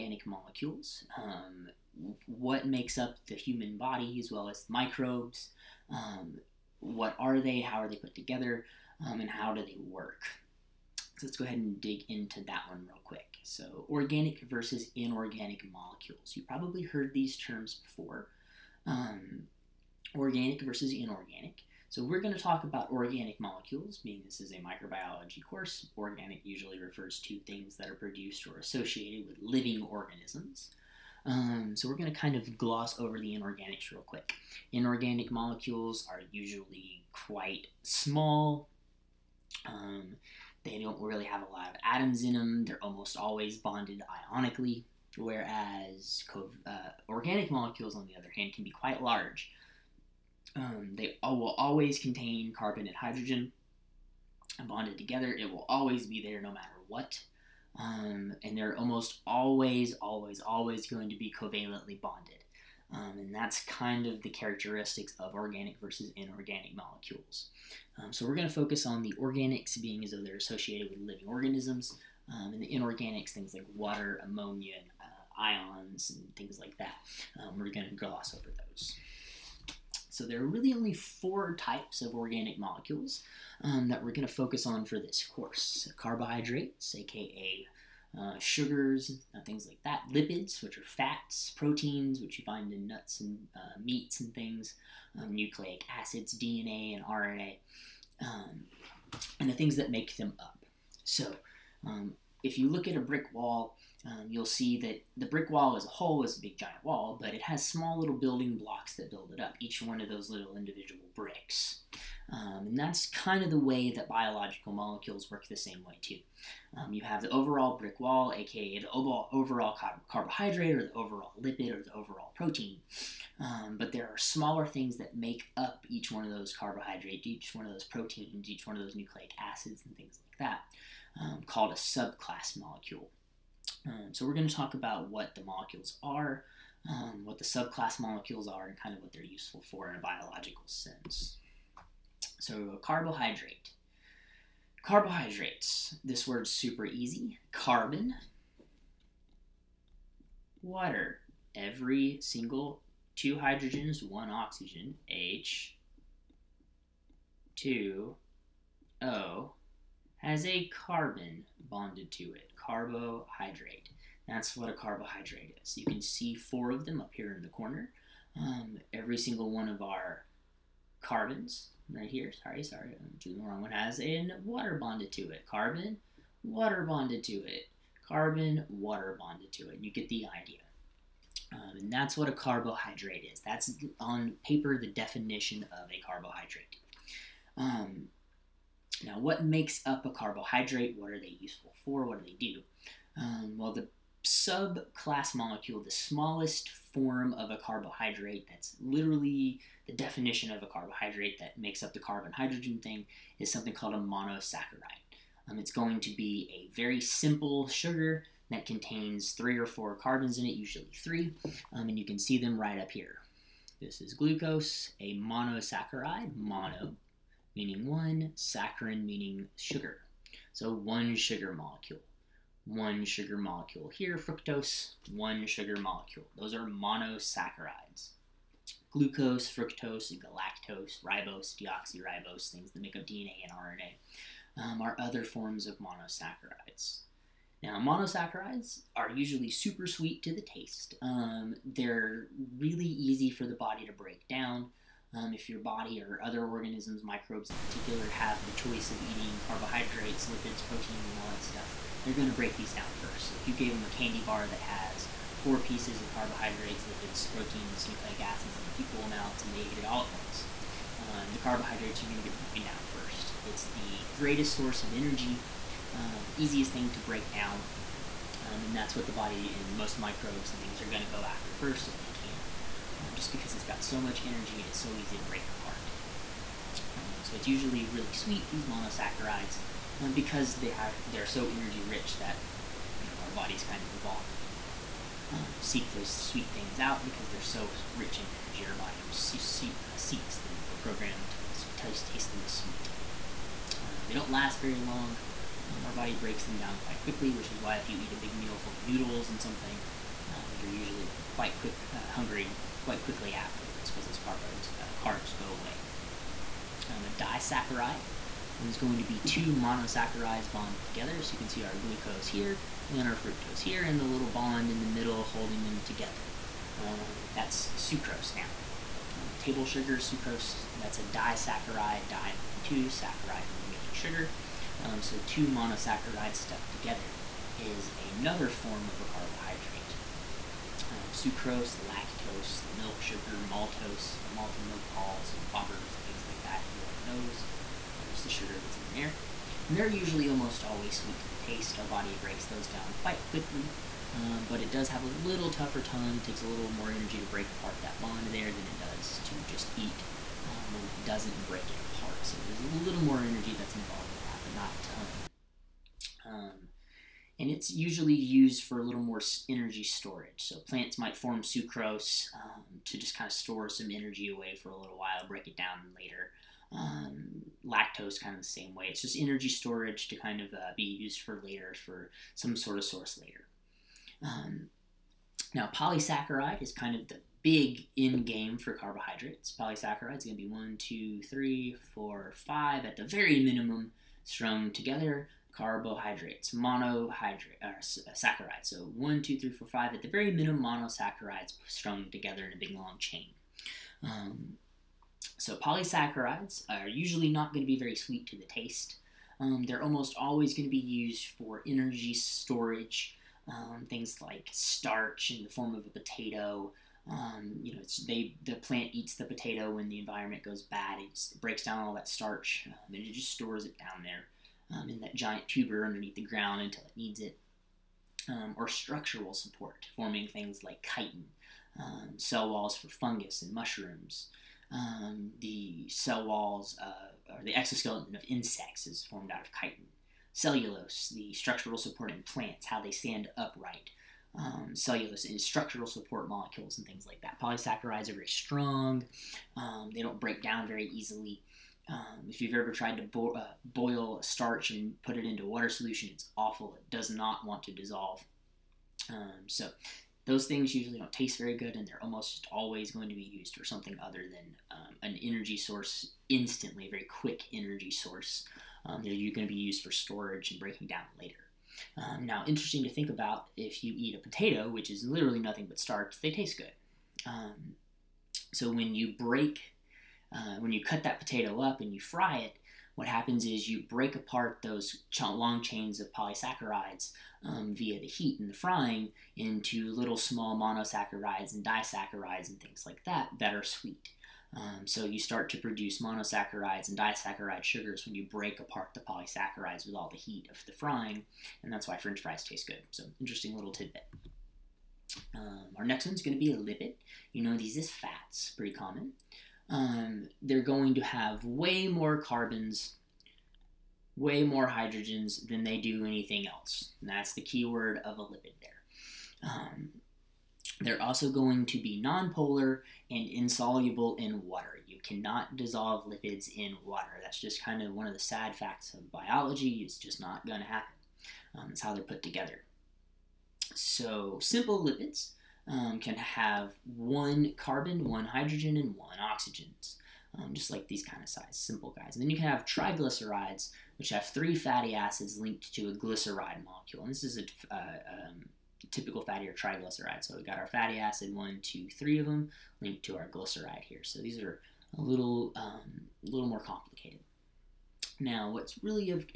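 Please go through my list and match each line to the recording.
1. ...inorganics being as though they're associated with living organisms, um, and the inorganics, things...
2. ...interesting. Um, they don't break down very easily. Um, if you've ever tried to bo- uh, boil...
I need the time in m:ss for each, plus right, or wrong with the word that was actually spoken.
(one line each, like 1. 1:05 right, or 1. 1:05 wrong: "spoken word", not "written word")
1. 1:09 wrong: "organics", not "inorganics"
2. 7:18 wrong: "strong", not "interesting".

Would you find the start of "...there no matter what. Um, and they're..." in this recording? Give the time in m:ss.
0:56.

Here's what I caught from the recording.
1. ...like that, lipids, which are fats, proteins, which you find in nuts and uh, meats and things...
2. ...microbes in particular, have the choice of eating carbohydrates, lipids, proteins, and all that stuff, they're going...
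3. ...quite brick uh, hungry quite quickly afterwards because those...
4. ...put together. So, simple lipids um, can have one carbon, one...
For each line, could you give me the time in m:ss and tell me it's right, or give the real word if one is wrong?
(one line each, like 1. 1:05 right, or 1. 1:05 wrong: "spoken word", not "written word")
1. 1:29 right
2. 4:07 right
3. 5:01 wrong: "quick", not "brick"
4. 8:42 right.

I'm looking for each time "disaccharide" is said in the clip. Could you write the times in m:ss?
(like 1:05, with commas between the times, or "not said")
5:07, 5:21, 8:01, 8:06.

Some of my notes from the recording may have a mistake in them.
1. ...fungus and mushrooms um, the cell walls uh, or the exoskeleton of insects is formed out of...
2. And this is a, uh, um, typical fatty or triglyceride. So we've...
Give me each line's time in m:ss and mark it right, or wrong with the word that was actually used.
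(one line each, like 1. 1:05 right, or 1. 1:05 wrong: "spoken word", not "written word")
1. 7:02 right
2. 8:57 right.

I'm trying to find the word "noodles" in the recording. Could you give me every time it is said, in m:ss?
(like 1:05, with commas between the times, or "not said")
4:58.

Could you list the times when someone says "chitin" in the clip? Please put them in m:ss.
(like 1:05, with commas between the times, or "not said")
7:00, 7:09.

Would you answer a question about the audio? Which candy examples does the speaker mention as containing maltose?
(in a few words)
Malted milk balls and Whoppers.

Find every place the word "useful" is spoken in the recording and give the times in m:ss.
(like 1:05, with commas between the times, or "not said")
2:19, 3:11.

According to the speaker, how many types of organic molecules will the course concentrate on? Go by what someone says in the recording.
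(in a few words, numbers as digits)
4.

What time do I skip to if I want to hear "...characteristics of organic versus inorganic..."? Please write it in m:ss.
1:04.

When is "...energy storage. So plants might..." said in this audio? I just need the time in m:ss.
5:59.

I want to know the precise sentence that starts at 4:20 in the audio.
Um, the carbohydrates are going to get broken down first.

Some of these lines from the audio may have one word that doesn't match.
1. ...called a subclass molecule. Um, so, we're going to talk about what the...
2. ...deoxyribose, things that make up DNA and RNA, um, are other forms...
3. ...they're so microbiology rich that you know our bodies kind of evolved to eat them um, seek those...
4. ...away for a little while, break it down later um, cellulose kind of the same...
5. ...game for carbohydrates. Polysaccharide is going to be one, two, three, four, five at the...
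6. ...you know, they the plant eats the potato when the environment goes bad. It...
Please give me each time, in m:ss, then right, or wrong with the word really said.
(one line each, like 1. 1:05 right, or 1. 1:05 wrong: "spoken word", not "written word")
1. 2:11 right
2. 3:51 right
3. 4:41 wrong: "energy", not "microbiology"
4. 6:04 wrong: "lactose", not "cellulose"
5. 6:18 right
6. 6:47 right.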